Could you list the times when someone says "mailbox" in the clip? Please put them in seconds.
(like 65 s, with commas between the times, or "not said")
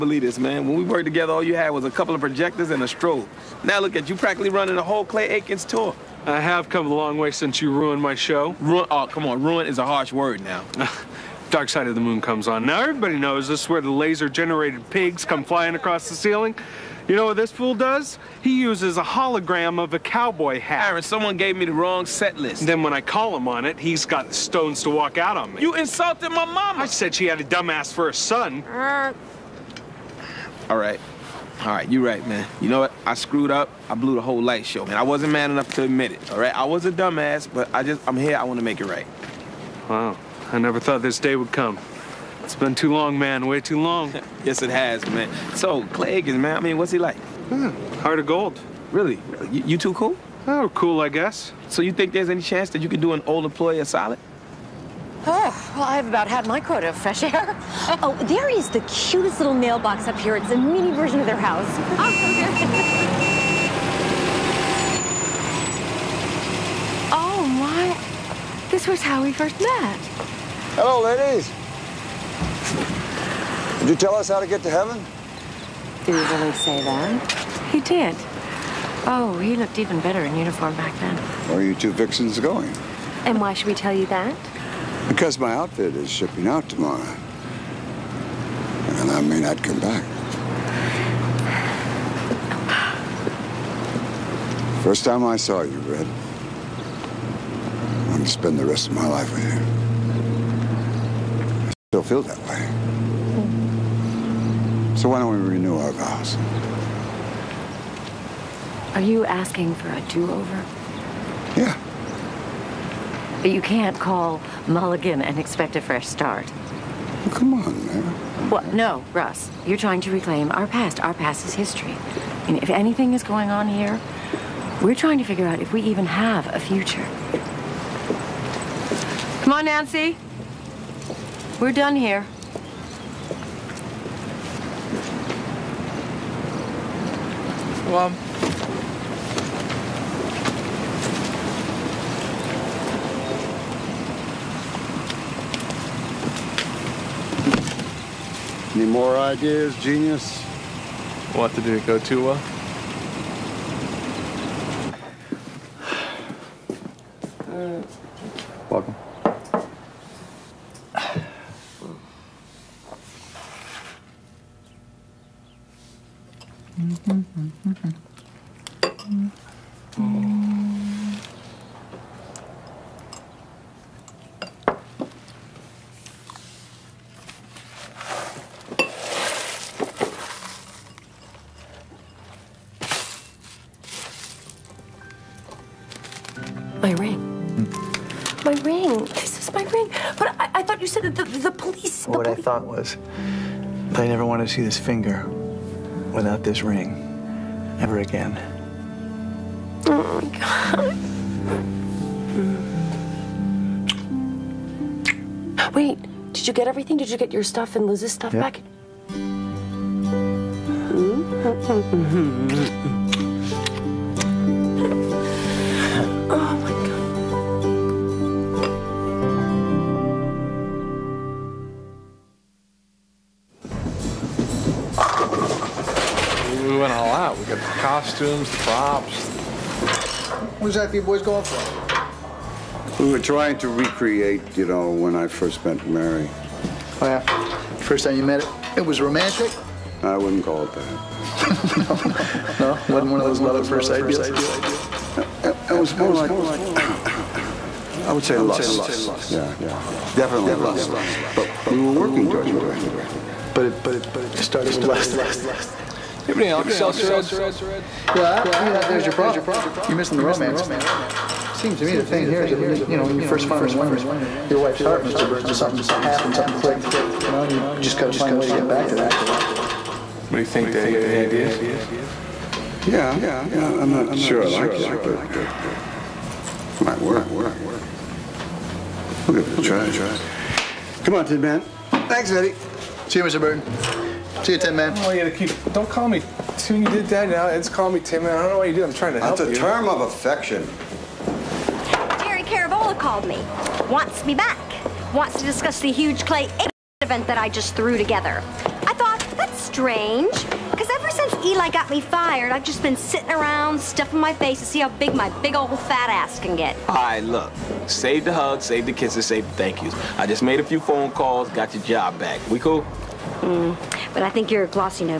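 59 s.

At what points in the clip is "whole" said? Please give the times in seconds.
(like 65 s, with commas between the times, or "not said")
4 s, 34 s.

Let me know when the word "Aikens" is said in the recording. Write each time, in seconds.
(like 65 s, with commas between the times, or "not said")
5 s.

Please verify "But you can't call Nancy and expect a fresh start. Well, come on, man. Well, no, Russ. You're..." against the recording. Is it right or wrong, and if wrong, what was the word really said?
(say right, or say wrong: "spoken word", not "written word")
wrong: "Mulligan", not "Nancy".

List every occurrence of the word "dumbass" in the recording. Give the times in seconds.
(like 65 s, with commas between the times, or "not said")
27 s, 36 s.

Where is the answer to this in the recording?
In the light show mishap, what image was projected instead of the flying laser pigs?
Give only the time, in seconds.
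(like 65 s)
19 s.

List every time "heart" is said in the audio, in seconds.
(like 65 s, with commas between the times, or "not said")
47 s, 264 s.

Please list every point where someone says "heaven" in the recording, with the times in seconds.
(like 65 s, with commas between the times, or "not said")
74 s.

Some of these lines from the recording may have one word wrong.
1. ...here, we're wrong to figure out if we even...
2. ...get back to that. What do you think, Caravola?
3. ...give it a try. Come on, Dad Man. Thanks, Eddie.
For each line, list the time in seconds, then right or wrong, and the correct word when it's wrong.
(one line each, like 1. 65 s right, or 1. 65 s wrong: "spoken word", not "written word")
1. 123 s wrong: "trying", not "wrong"
2. 268 s wrong: "Dad", not "Caravola"
3. 279 s wrong: "Tin", not "Dad".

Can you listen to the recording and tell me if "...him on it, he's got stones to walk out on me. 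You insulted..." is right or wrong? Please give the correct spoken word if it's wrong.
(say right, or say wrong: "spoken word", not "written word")
right.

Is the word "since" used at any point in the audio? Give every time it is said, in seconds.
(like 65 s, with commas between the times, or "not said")
7 s, 301 s.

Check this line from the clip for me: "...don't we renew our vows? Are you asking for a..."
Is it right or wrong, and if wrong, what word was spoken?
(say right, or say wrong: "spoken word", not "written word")
right.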